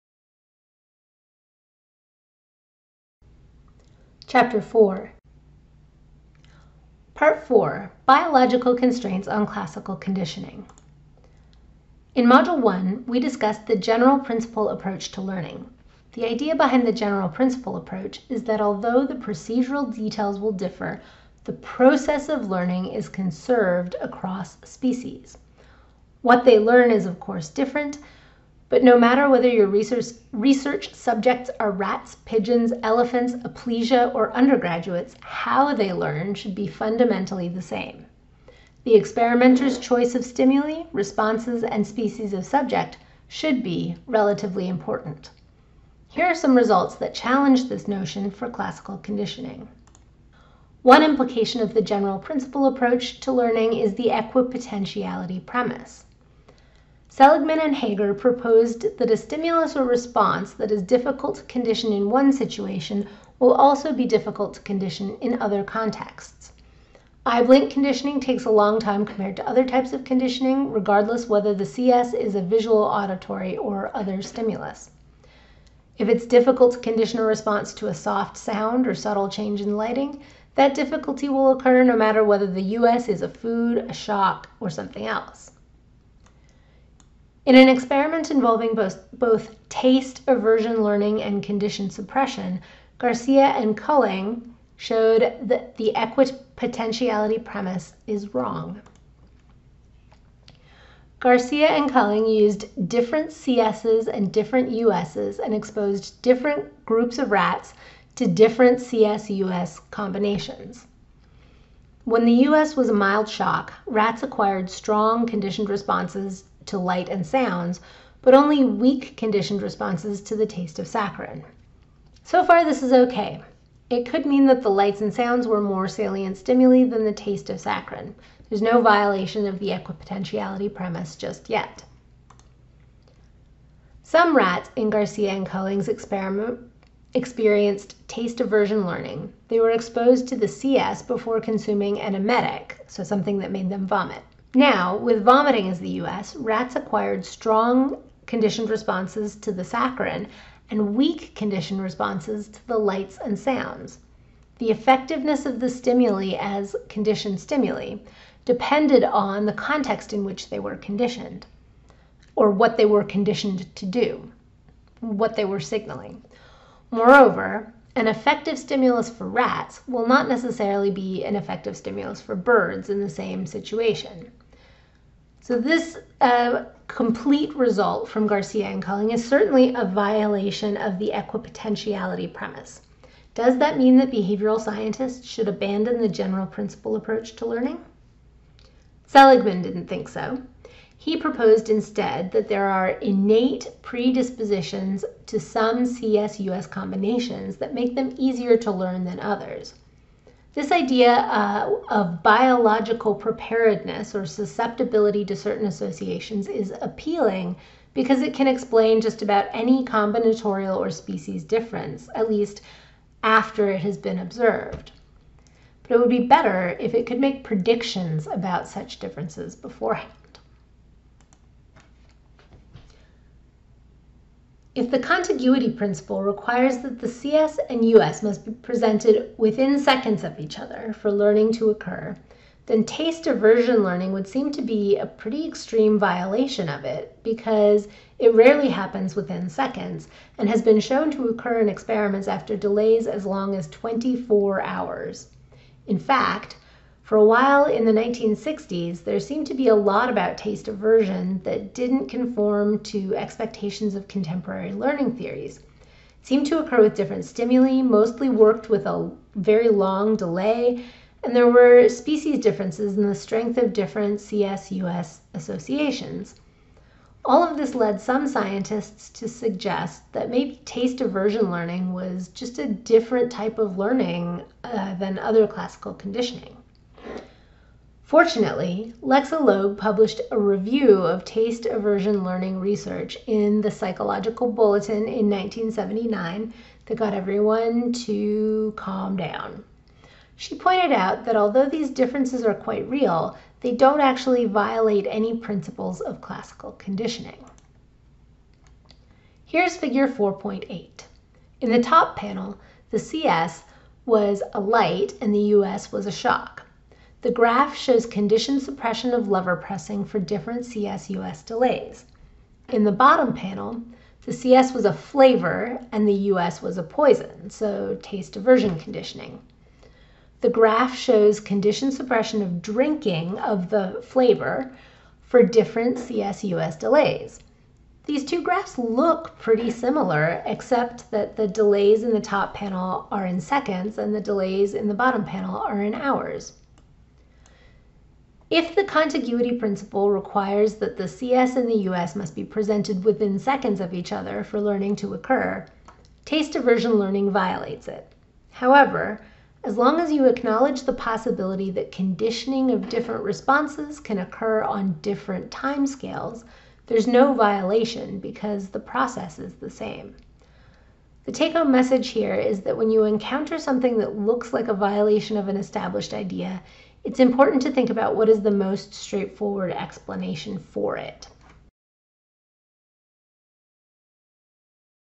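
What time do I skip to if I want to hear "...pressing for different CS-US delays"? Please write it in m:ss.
5:09.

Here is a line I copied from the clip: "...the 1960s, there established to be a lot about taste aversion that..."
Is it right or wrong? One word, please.
wrong.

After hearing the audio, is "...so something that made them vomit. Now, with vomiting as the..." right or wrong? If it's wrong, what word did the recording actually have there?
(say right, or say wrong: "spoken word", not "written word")
right.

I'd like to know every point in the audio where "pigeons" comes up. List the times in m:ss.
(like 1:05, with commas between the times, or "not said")
0:32.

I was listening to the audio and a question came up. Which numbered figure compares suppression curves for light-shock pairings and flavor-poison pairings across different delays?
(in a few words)
Figure 4.8.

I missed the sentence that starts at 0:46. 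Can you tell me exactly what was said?
Here are some results that challenge this notion for classical conditioning.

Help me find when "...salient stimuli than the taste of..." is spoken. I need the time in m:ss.
2:05.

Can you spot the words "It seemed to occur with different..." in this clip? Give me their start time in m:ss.
4:15.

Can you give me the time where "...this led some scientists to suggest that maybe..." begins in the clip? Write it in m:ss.
4:27.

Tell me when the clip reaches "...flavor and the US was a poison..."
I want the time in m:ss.
5:14.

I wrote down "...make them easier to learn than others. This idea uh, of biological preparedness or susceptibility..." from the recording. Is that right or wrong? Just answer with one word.
right.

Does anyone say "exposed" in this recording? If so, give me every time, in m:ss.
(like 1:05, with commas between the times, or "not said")
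1:45, 2:19.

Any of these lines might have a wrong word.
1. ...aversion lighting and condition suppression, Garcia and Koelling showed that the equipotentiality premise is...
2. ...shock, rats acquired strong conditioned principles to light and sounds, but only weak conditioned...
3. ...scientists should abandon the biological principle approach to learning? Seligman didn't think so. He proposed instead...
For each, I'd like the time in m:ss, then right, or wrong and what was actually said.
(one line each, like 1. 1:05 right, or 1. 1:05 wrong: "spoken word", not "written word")
1. 1:30 wrong: "learning", not "lighting"
2. 1:53 wrong: "responses", not "principles"
3. 3:04 wrong: "general", not "biological".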